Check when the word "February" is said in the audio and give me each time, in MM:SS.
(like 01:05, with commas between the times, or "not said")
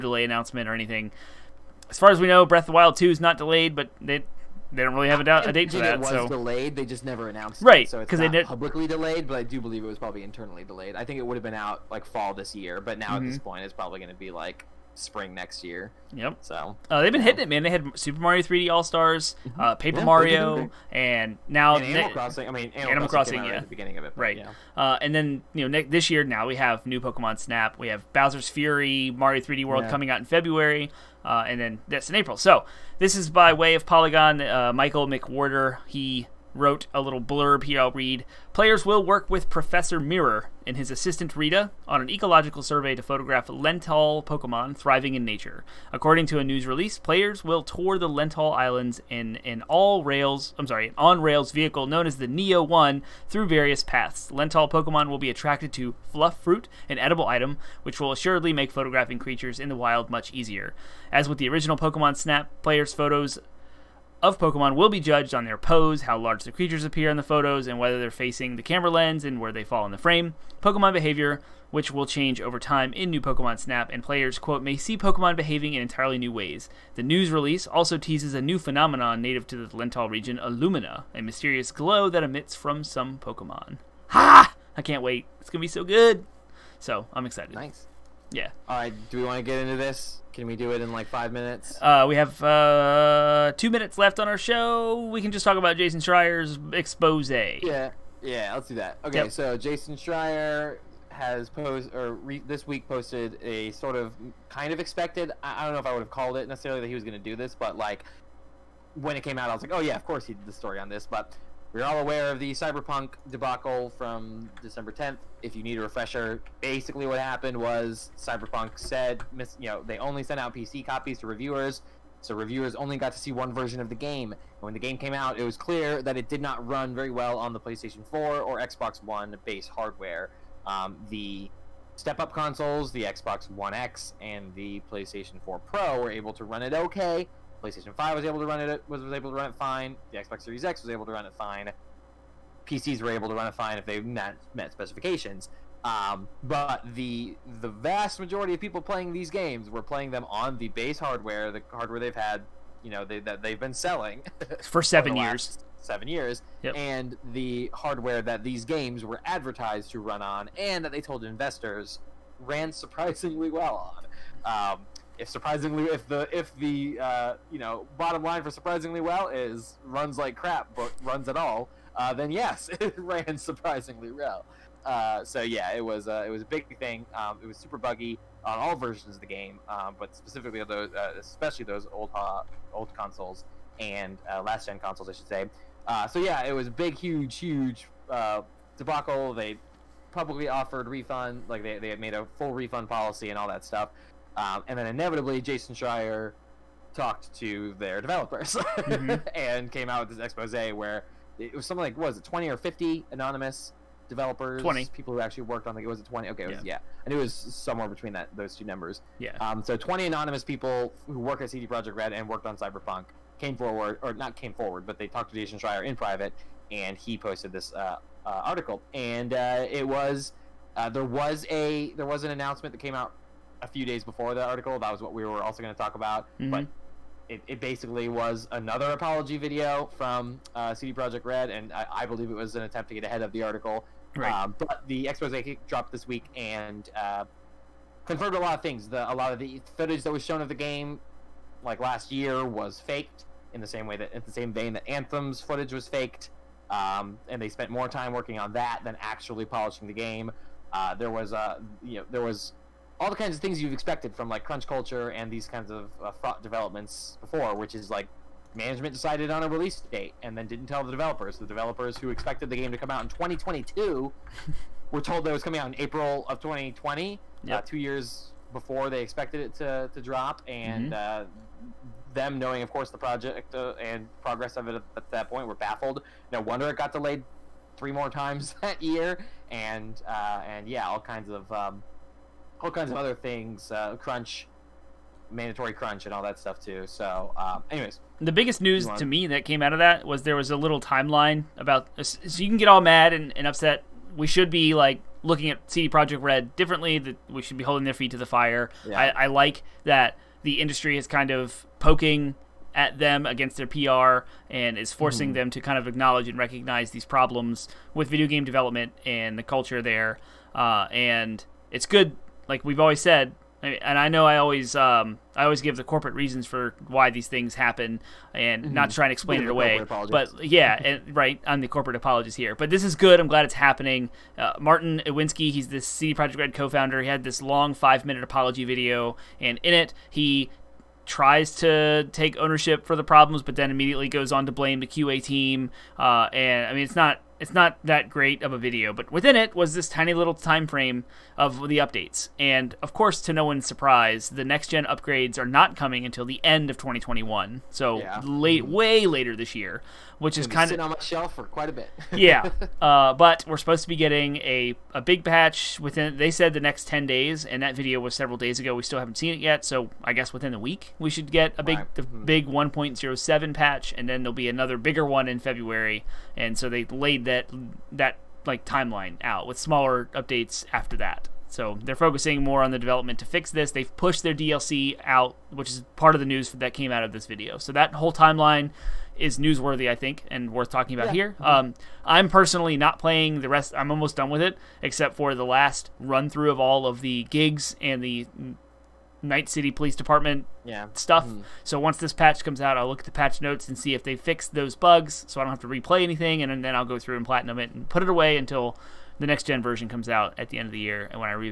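00:30, 06:05.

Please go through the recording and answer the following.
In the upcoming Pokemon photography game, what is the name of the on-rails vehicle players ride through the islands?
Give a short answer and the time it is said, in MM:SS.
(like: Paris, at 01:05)
Neo 1, at 00:52.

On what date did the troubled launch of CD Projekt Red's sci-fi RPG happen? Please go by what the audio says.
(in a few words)
December 10th.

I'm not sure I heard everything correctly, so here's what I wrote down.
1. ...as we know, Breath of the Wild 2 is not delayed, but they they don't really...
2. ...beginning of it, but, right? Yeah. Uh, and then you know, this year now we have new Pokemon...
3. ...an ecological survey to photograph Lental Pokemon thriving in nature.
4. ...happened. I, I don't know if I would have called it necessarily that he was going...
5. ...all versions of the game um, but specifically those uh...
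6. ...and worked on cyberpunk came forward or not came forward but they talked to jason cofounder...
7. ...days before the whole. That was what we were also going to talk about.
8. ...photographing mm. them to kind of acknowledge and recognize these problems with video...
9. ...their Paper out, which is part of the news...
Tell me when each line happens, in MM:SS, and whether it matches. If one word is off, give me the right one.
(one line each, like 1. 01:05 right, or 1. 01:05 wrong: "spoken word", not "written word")
1. 00:02 right
2. 00:23 right
3. 00:42 right
4. 01:44 wrong: "expected", not "happened"
5. 02:58 right
6. 03:32 wrong: "schreier", not "cofounder"
7. 03:43 wrong: "article", not "whole"
8. 05:04 wrong: "forcing", not "photographing"
9. 06:14 wrong: "DLC", not "Paper".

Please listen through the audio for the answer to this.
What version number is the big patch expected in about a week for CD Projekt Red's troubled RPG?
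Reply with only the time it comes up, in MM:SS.
06:02.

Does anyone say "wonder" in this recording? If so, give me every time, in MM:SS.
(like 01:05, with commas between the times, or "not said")
04:36.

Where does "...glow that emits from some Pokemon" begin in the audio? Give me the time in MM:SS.
01:21.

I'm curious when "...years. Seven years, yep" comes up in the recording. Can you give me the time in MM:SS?
02:35.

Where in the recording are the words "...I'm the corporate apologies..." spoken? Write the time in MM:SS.
05:21.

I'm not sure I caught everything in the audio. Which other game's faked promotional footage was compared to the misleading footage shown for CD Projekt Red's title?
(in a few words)
Anthem.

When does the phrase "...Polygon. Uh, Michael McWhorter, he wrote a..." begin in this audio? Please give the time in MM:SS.
00:33.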